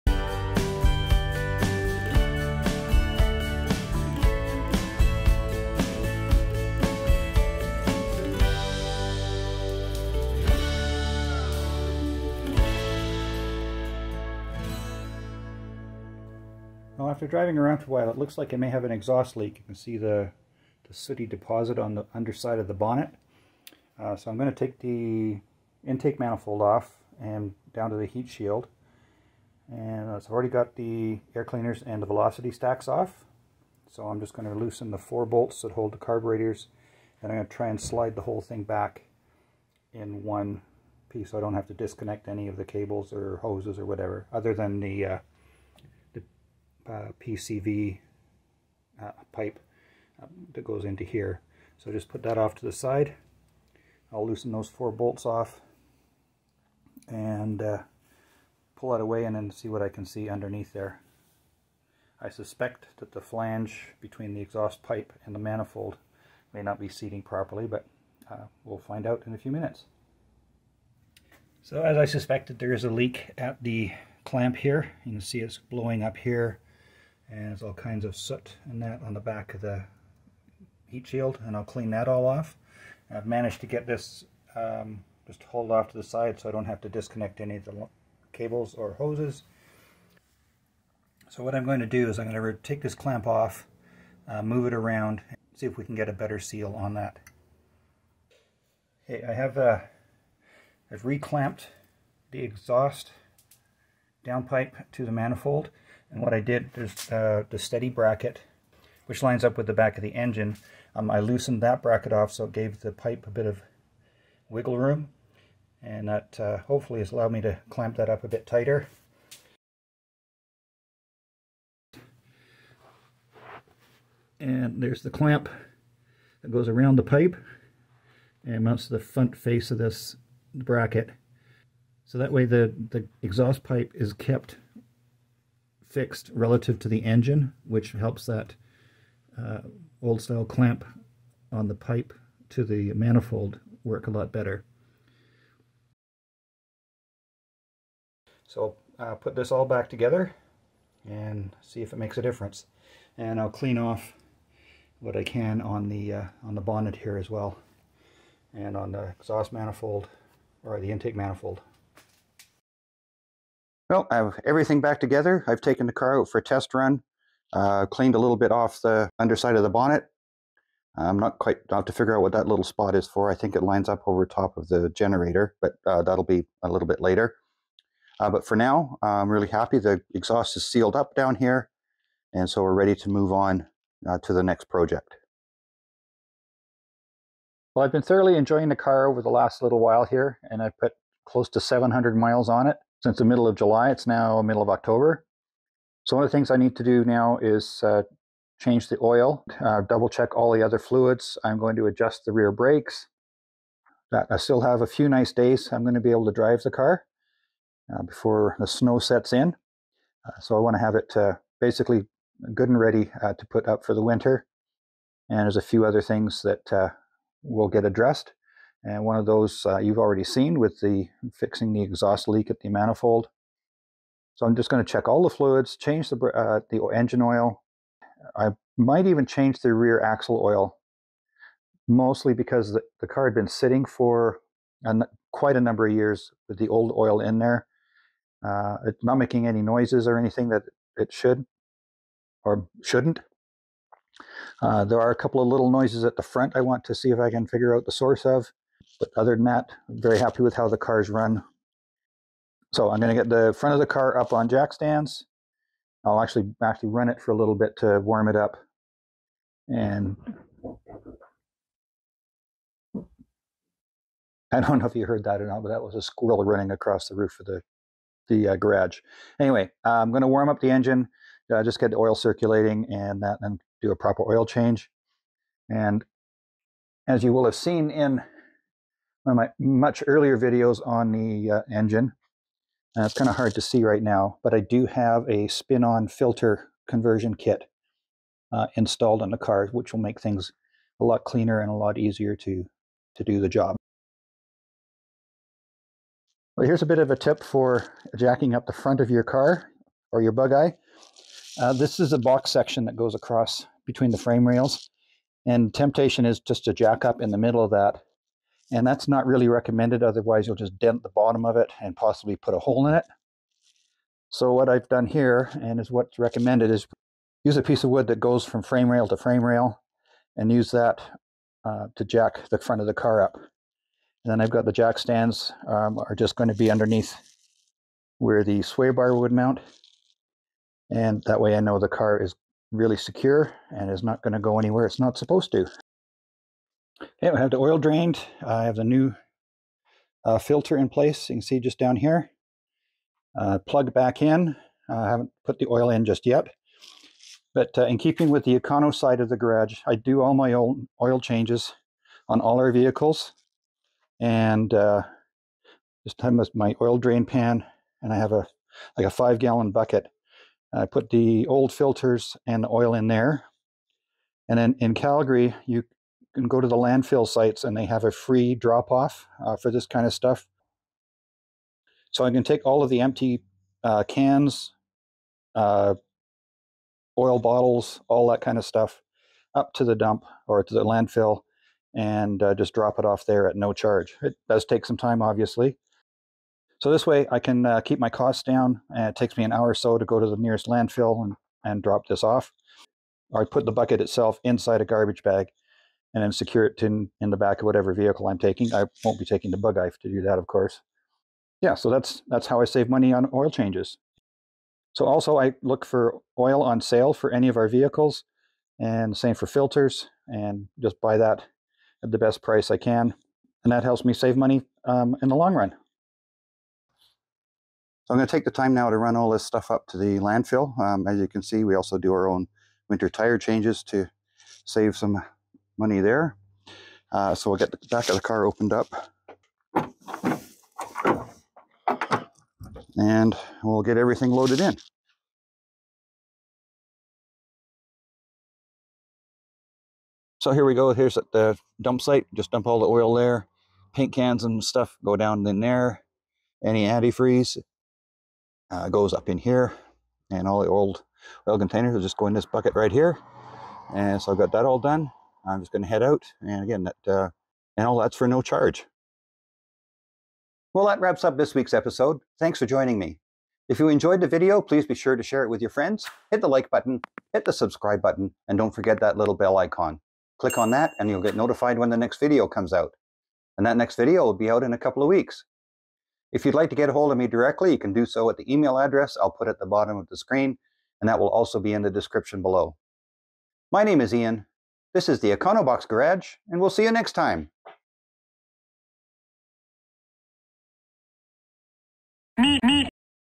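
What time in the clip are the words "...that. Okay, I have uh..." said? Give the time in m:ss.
1:36.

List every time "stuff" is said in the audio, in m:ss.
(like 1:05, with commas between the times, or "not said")
6:10, 6:18, 6:59, 7:24.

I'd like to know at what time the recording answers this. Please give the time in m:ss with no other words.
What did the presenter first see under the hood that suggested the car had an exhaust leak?
0:20.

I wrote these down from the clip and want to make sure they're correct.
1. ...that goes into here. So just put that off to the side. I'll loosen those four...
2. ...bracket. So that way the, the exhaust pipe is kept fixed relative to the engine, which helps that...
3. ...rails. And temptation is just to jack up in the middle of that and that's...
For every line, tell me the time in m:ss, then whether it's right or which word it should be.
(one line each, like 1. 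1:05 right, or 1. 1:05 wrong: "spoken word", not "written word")
1. 0:50 right
2. 2:10 right
3. 5:04 right.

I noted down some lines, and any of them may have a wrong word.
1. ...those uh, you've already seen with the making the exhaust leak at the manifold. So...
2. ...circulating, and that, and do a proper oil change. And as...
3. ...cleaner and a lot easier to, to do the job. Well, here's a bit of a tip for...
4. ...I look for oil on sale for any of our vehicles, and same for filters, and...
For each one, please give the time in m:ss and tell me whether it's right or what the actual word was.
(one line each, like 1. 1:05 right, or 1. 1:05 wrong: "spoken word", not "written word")
1. 3:39 wrong: "fixing", not "making"
2. 4:32 right
3. 4:51 right
4. 6:45 right.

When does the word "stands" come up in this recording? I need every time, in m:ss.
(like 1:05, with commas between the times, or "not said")
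4:14, 5:24.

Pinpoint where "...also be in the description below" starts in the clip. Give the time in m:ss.
8:01.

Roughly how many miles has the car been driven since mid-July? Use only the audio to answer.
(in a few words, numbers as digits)
700.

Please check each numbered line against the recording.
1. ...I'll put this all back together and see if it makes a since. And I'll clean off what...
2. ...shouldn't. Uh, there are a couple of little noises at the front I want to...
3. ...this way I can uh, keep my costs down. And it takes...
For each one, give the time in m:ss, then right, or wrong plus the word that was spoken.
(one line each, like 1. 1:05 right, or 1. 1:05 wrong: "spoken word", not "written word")
1. 2:28 wrong: "difference", not "since"
2. 4:02 right
3. 6:26 right.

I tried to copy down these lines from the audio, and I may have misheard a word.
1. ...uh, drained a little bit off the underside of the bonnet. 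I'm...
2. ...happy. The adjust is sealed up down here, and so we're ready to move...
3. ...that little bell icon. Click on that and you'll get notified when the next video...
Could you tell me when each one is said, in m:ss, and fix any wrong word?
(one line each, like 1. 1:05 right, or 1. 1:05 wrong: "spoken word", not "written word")
1. 2:47 wrong: "cleaned", not "drained"
2. 2:59 wrong: "exhaust", not "adjust"
3. 7:48 right.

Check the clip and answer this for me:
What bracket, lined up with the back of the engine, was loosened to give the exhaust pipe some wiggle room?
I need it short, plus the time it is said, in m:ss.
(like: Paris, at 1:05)
steady bracket, at 1:47.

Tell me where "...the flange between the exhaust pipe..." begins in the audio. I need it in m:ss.
1:03.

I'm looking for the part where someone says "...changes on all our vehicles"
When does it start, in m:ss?
5:51.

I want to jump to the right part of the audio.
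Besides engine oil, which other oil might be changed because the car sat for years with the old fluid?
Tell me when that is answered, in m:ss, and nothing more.
3:49.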